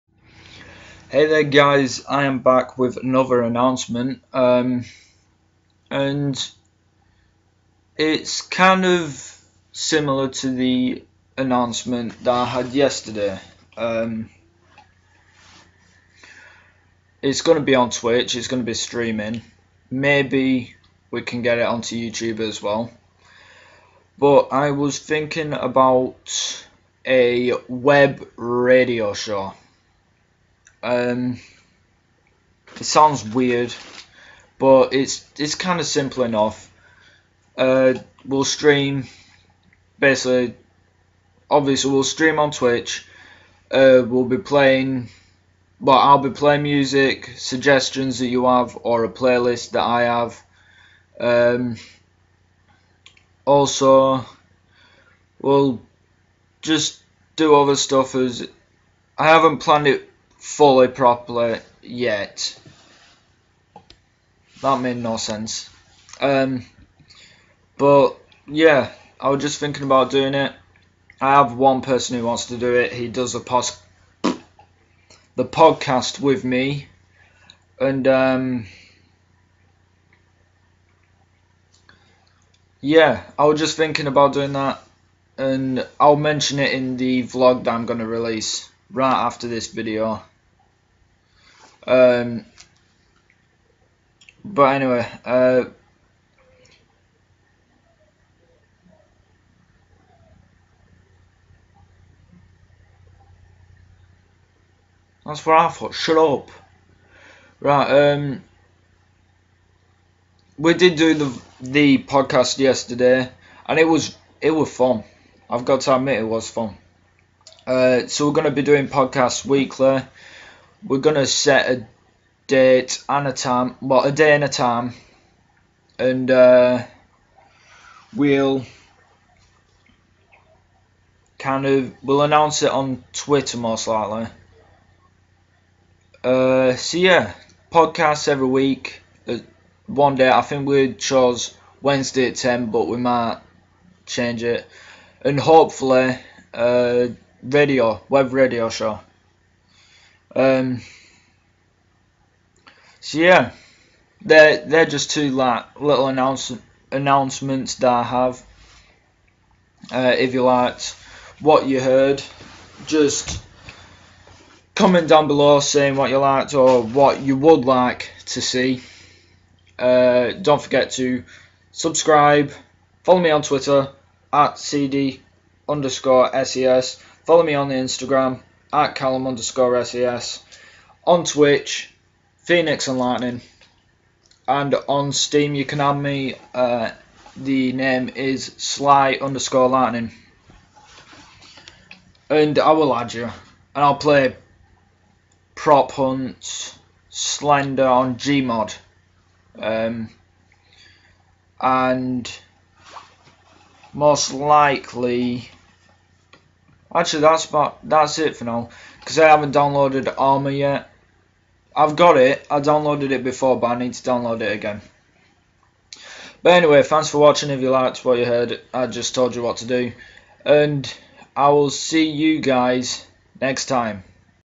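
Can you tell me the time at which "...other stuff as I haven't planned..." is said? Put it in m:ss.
0:57.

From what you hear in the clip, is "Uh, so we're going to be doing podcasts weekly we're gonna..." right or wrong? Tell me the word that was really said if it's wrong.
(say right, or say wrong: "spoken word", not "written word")
right.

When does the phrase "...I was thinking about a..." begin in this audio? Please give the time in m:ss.
0:24.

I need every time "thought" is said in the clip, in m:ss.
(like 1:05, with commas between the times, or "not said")
1:45.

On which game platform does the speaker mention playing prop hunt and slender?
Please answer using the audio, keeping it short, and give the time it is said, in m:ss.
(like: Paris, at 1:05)
Gmod, at 3:18.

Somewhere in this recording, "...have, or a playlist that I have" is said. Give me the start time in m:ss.
0:48.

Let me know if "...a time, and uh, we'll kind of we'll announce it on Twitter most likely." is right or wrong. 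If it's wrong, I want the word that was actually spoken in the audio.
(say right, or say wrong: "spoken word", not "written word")
right.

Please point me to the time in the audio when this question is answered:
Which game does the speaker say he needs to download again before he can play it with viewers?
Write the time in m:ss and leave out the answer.
3:30.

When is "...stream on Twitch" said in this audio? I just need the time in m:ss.
0:42.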